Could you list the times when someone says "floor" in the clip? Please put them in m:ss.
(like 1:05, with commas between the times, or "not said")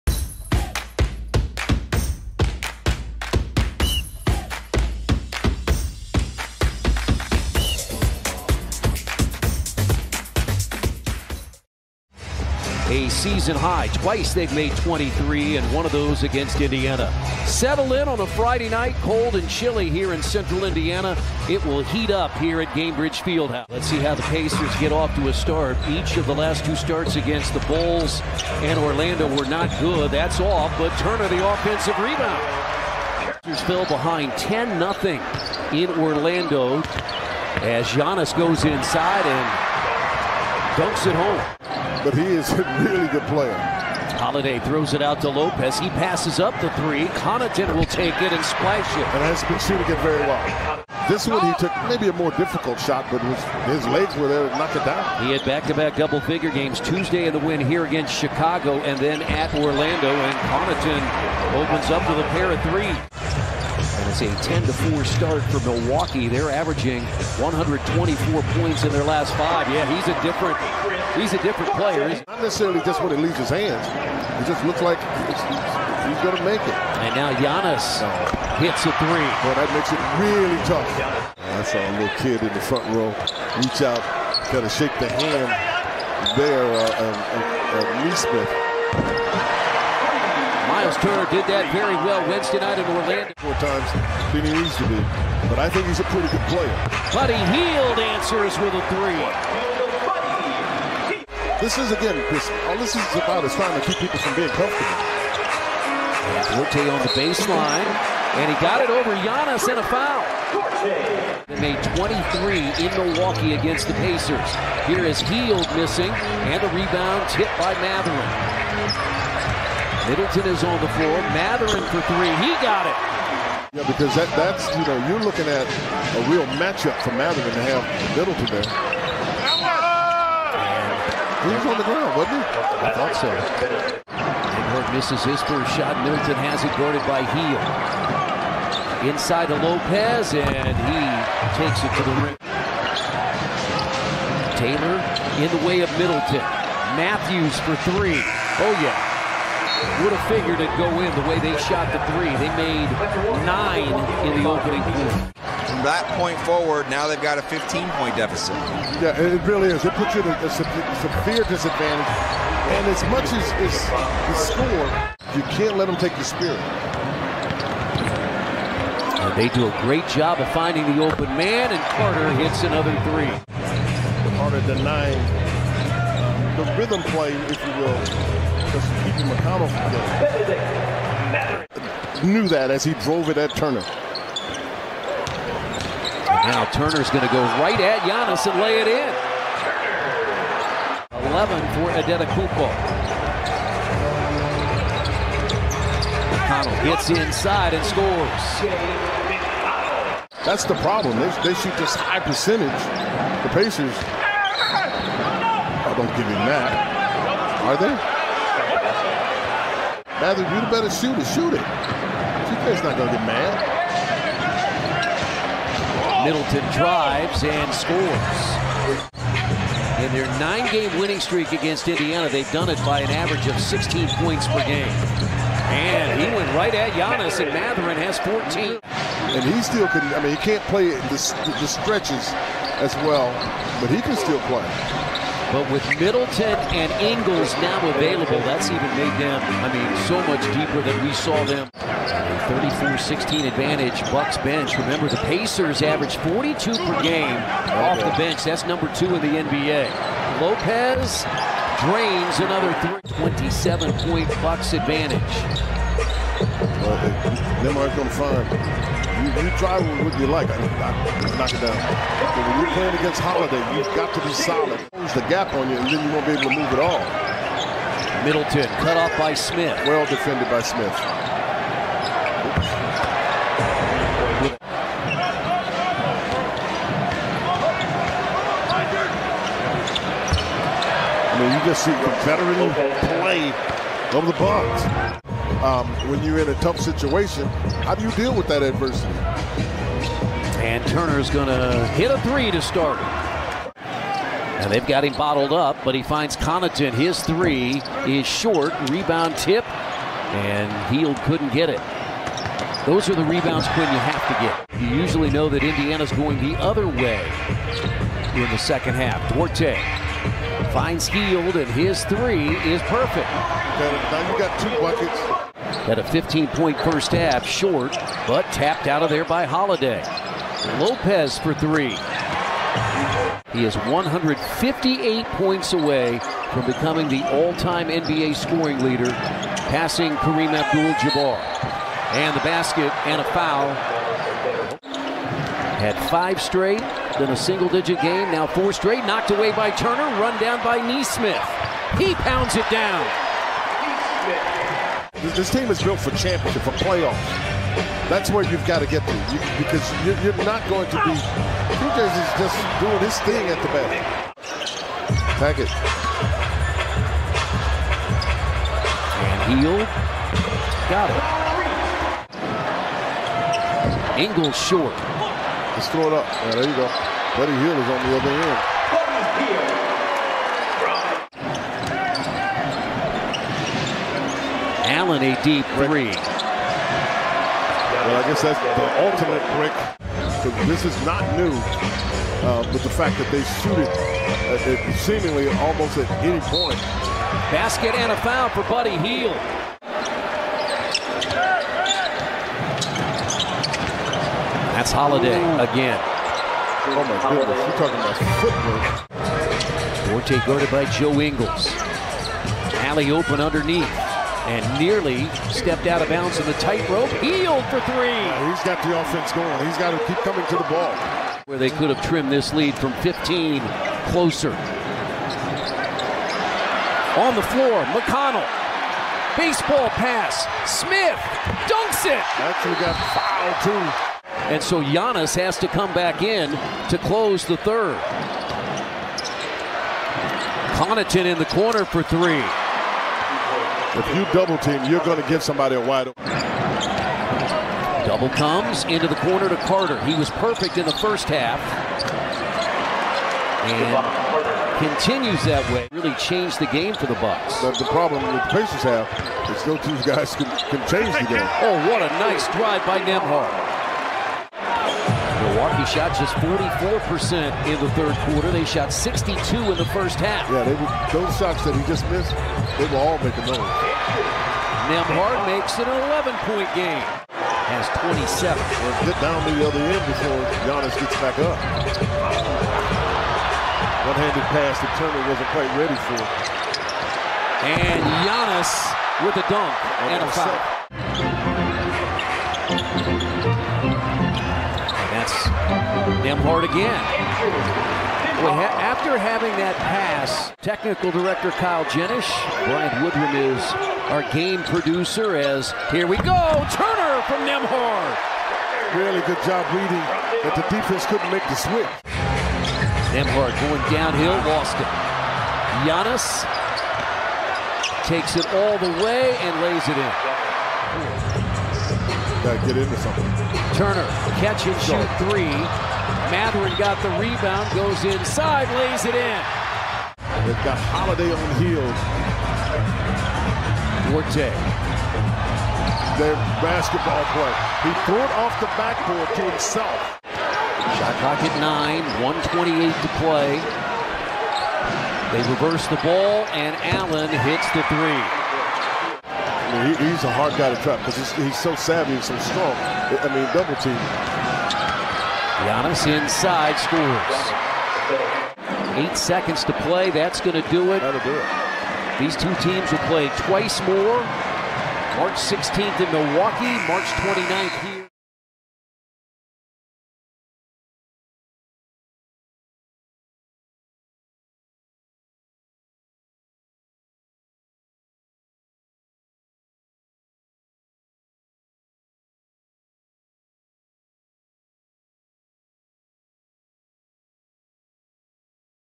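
2:00, 6:57.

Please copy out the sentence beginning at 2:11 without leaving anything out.
He was on the ground, wasn't he?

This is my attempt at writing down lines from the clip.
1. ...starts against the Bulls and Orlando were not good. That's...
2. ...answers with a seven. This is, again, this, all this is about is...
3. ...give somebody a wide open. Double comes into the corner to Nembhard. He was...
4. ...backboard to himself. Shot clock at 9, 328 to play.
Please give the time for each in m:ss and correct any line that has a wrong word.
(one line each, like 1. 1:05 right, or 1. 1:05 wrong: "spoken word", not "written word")
1. 0:26 right
2. 1:37 wrong: "three", not "seven"
3. 7:15 wrong: "Carter", not "Nembhard"
4. 8:48 wrong: "128", not "328".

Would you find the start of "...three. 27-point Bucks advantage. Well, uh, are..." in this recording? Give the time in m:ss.
4:12.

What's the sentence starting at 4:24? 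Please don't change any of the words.
Close the gap on you, and then you won't be able to move at all.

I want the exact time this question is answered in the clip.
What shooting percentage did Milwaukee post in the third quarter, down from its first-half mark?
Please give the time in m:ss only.
7:36.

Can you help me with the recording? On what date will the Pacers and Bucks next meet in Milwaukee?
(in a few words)
March 16.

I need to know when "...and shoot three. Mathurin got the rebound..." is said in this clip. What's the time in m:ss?
8:34.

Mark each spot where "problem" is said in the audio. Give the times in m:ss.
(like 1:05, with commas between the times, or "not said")
3:20, 7:27.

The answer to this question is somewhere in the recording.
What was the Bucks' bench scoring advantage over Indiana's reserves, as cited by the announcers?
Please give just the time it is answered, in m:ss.
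4:02.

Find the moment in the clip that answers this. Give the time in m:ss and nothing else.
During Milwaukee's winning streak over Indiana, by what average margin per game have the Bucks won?
3:43.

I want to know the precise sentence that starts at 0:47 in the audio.
Connaughton will take it and splash it.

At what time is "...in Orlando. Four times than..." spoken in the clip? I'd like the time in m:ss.
1:32.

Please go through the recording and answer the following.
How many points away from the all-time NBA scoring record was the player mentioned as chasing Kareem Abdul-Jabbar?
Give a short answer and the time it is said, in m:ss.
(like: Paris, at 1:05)
158, at 5:23.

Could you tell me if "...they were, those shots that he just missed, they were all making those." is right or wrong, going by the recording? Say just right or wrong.
right.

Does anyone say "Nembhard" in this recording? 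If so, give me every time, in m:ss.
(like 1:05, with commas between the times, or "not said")
7:32, 7:44, 8:06, 8:17, 8:23.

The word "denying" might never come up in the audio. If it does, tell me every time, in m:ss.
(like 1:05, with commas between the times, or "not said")
2:54.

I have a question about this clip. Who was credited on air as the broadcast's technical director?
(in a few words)
Kyle Jenish.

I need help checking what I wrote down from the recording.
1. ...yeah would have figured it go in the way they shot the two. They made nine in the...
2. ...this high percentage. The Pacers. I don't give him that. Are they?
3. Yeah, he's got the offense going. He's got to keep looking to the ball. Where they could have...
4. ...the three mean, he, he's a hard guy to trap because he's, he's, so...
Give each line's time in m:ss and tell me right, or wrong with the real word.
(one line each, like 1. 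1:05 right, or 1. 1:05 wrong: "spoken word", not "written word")
1. 2:28 wrong: "three", not "two"
2. 3:21 right
3. 6:48 wrong: "coming", not "looking"
4. 8:57 right.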